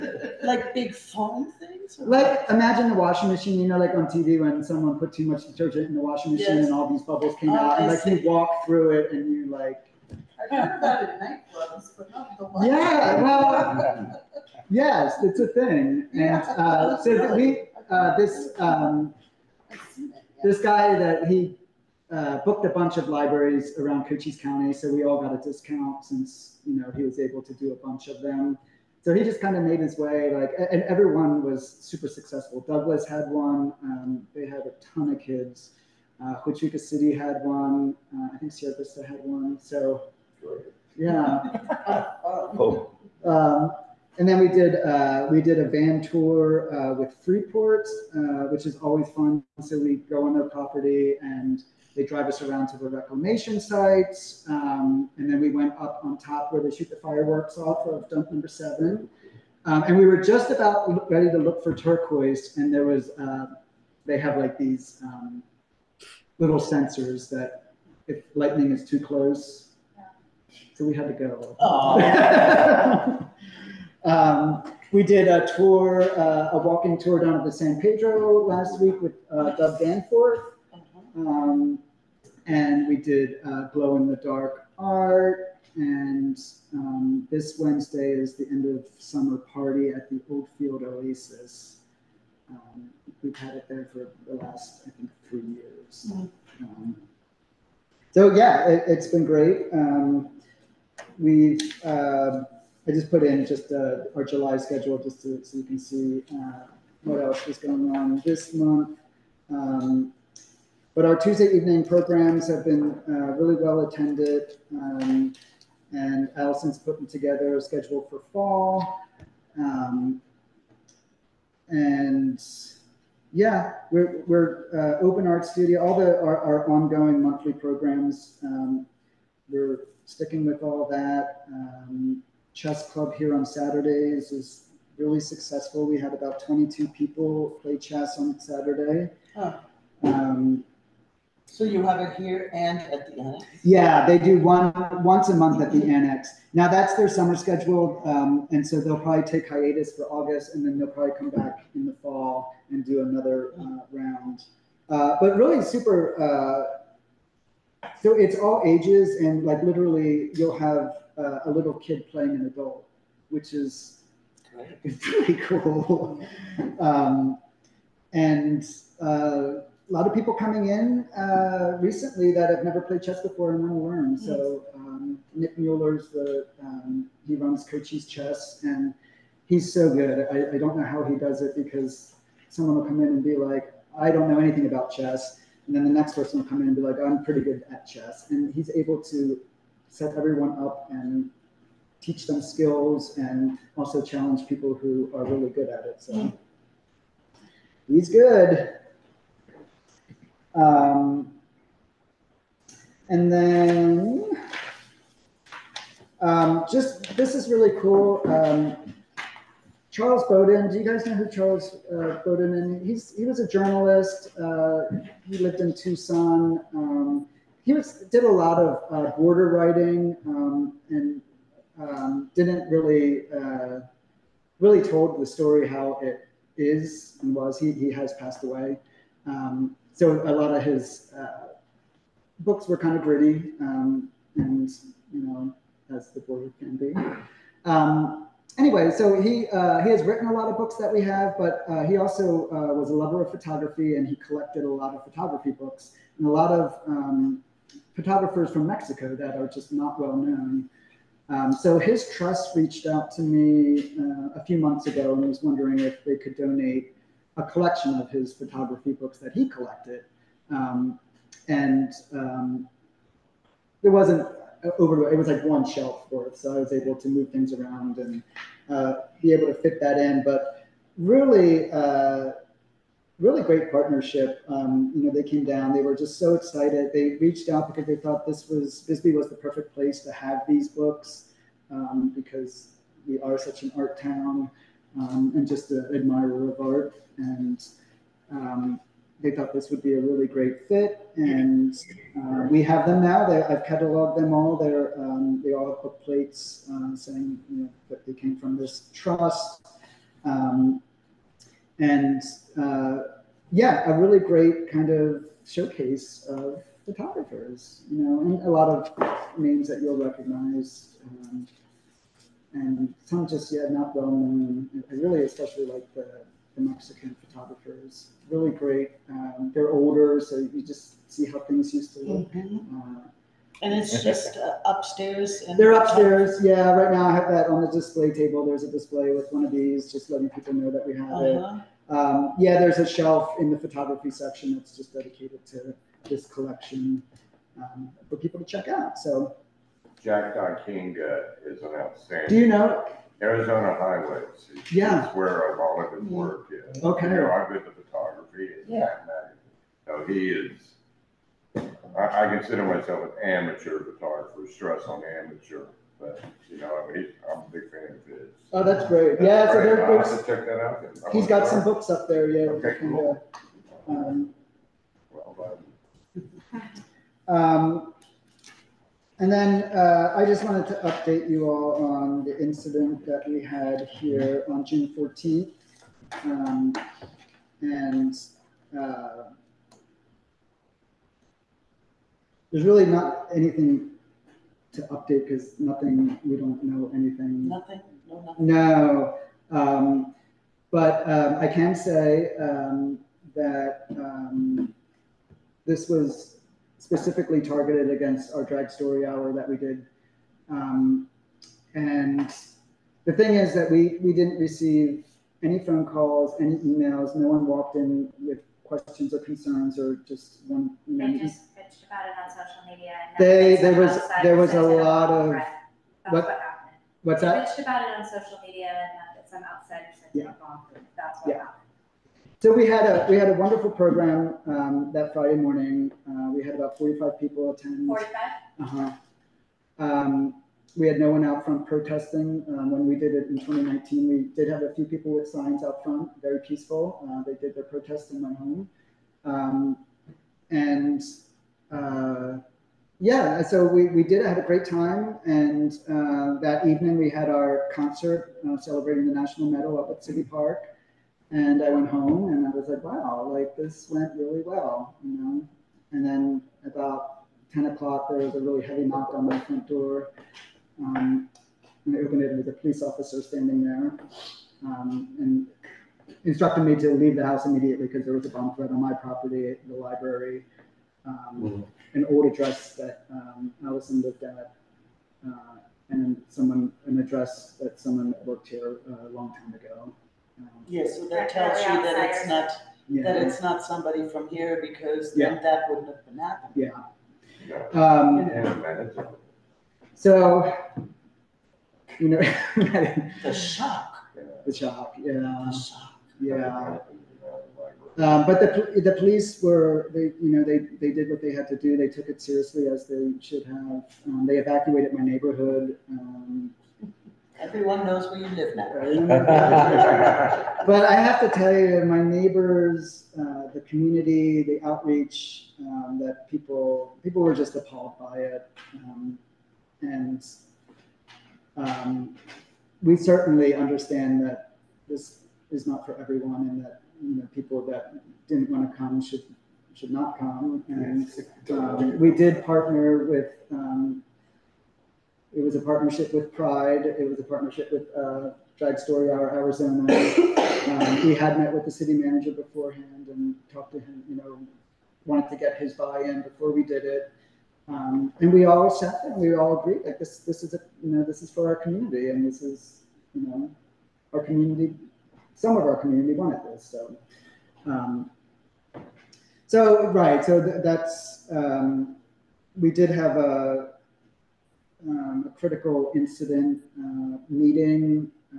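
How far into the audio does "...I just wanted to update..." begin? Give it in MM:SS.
06:10.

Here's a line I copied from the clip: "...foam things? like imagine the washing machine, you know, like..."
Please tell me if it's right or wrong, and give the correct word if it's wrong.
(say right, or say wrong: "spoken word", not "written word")
right.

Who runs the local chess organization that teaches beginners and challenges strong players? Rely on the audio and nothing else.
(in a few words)
Nick Mueller.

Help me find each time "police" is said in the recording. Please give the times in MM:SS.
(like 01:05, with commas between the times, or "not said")
07:42, 08:18.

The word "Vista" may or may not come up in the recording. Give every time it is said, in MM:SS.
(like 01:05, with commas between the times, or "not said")
00:38.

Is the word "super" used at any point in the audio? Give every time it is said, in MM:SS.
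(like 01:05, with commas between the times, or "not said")
00:31, 02:35.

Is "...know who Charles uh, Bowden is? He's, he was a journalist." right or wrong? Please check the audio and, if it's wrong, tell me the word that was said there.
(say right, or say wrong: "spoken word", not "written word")
right.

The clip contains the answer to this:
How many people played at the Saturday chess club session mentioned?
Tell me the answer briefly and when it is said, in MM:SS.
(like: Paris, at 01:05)
22, at 02:16.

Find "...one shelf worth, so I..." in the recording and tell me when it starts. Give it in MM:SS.
04:25.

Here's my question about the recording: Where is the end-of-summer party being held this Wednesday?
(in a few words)
Old Field Oasis.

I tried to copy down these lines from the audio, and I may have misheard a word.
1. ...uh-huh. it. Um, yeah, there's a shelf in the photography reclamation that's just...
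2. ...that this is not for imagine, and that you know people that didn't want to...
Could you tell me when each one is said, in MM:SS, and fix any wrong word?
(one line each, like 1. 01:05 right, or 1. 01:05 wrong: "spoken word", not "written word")
1. 05:31 wrong: "section", not "reclamation"
2. 08:44 wrong: "everyone", not "imagine".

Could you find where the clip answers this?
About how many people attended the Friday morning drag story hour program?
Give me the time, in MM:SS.
07:06.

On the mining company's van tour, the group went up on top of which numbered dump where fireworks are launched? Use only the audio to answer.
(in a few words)
Dump number 7.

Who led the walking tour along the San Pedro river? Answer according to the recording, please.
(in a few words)
Dub Danforth.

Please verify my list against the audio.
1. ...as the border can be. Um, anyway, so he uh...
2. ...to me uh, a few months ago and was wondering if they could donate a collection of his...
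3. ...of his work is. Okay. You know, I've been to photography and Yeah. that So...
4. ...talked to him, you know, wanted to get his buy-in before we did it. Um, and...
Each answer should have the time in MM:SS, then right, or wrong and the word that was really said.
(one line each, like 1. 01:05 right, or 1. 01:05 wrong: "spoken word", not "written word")
1. 03:55 right
2. 04:13 right
3. 05:45 right
4. 09:03 right.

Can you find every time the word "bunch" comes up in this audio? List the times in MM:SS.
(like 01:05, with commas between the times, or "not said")
00:22, 00:27.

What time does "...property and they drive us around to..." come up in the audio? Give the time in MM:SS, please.
00:50.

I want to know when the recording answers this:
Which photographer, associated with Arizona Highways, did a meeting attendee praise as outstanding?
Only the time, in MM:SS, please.
05:40.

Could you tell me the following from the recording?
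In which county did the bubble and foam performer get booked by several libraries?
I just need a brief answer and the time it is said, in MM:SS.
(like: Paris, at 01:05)
Cochise County, at 00:24.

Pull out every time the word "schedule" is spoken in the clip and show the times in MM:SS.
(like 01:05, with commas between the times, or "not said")
01:44, 01:57, 02:27.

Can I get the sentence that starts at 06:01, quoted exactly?
he's got some books up there, yeah.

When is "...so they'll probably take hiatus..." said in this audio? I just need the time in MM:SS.
02:28.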